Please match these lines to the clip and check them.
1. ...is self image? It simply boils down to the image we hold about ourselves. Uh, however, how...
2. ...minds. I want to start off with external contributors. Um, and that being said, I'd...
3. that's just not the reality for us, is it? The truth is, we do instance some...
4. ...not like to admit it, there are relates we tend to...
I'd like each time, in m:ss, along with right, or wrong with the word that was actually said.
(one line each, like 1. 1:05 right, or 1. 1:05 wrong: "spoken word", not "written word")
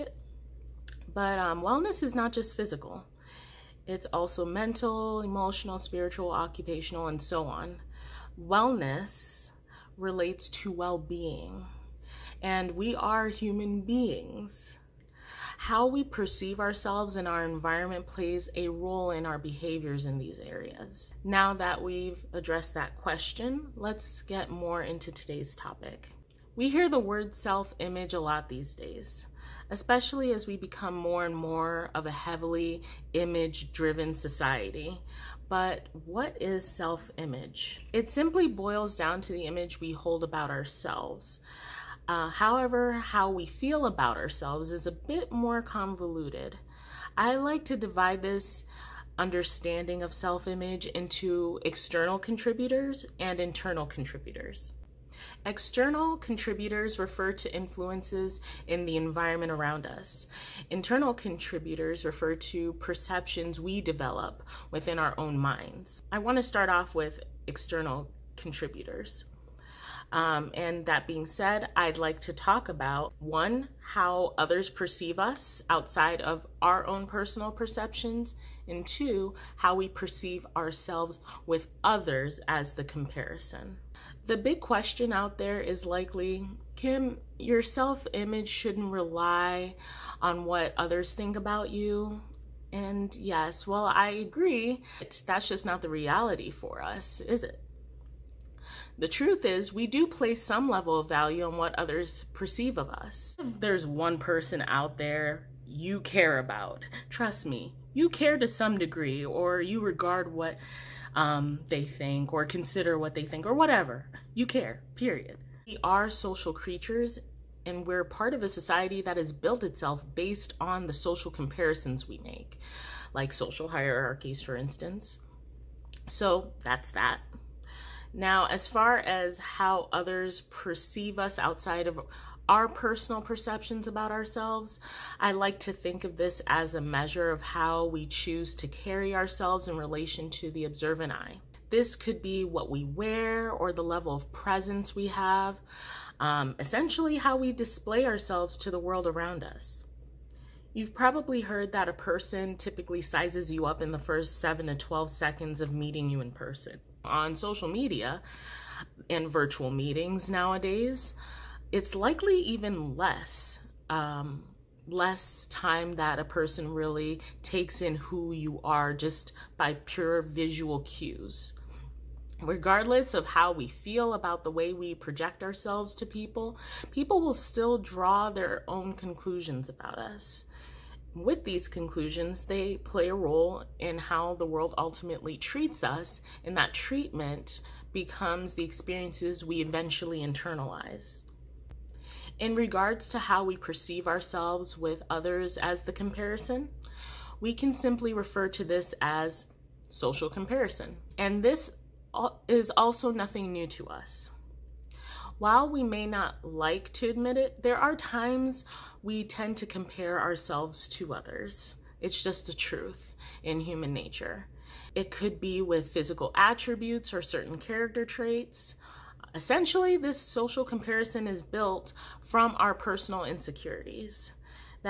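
1. 0:36 right
2. 1:05 right
3. 1:35 wrong: "place", not "instance"
4. 3:26 wrong: "times", not "relates".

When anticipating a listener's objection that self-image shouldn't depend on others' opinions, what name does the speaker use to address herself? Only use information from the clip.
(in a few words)
Kim.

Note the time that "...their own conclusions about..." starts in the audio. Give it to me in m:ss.
2:58.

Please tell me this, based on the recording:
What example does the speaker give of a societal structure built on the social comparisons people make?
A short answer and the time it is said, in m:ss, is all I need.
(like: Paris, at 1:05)
Social hierarchies, at 2:03.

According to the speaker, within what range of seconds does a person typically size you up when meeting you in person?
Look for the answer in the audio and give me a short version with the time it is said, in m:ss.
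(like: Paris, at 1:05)
7 to 12 seconds, at 2:34.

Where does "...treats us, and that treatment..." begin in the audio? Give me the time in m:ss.
3:05.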